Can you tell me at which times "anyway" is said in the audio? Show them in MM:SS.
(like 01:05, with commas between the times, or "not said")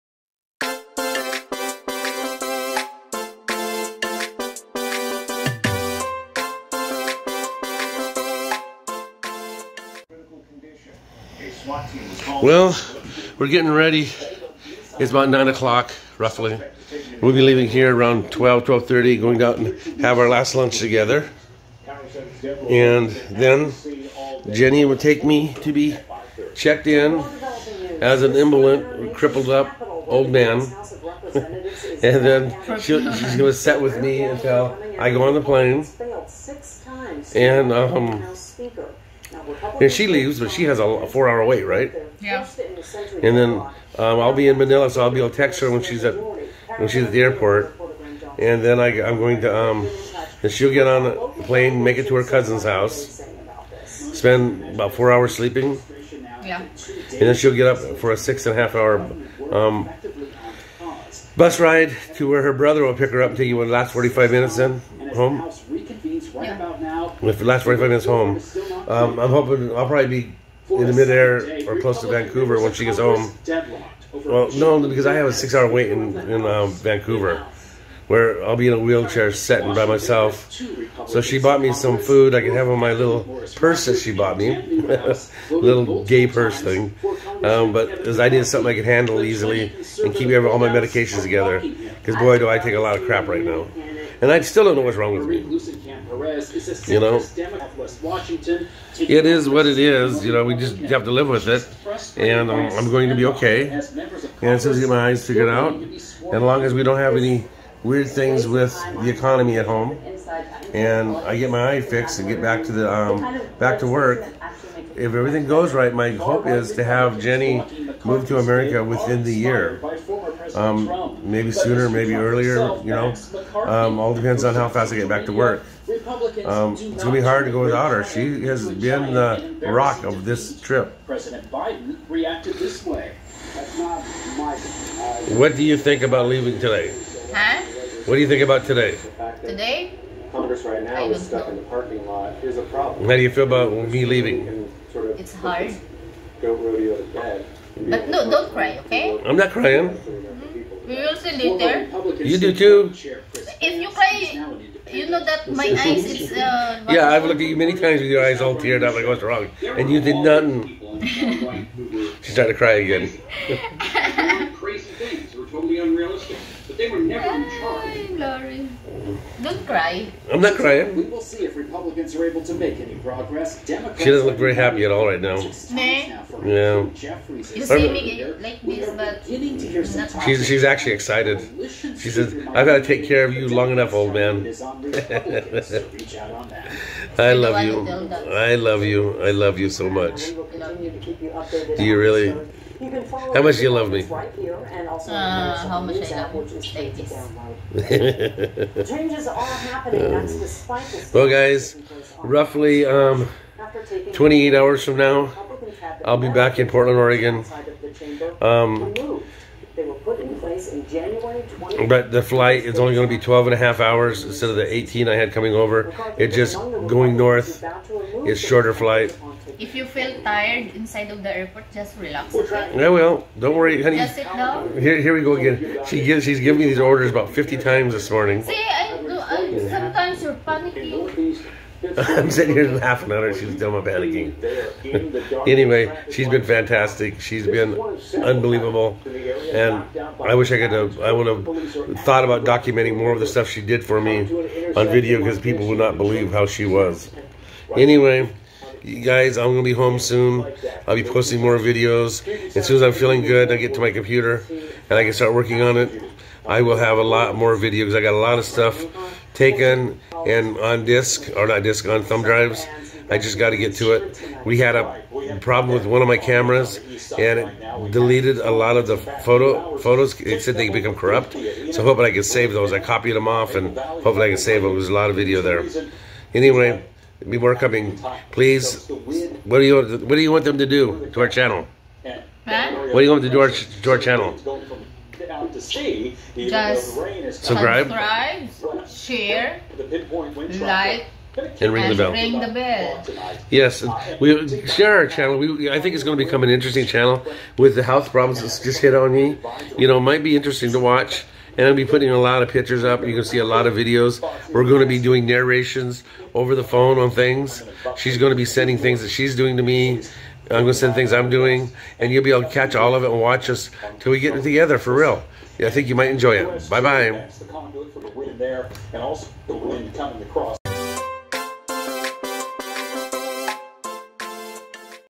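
03:55, 04:07, 04:36.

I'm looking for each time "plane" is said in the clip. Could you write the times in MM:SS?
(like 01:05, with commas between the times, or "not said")
00:35, 00:51.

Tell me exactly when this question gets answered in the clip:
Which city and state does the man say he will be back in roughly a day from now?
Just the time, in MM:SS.
03:26.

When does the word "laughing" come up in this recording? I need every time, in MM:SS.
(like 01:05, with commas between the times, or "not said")
03:52.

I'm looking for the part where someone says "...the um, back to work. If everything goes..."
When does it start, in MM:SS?
01:52.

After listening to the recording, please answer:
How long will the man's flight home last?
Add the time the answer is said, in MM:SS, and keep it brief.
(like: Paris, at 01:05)
12.5 hours, at 03:33.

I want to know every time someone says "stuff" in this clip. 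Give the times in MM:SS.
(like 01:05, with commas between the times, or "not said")
04:03, 04:18.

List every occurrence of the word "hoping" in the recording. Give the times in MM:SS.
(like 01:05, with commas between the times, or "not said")
01:09, 04:31.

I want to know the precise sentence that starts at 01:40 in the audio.
You know, we just have to live with it, and I'm, um, I'm going to be okay.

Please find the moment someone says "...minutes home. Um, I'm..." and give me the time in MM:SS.
01:07.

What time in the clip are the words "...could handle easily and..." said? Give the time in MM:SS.
01:28.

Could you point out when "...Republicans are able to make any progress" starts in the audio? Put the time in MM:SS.
02:51.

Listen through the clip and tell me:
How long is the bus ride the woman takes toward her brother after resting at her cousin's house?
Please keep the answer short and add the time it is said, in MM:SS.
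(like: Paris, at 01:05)
6.5 hours, at 00:58.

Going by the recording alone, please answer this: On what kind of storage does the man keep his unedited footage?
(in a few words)
Thumb drives.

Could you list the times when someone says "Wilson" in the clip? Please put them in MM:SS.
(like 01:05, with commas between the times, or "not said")
not said.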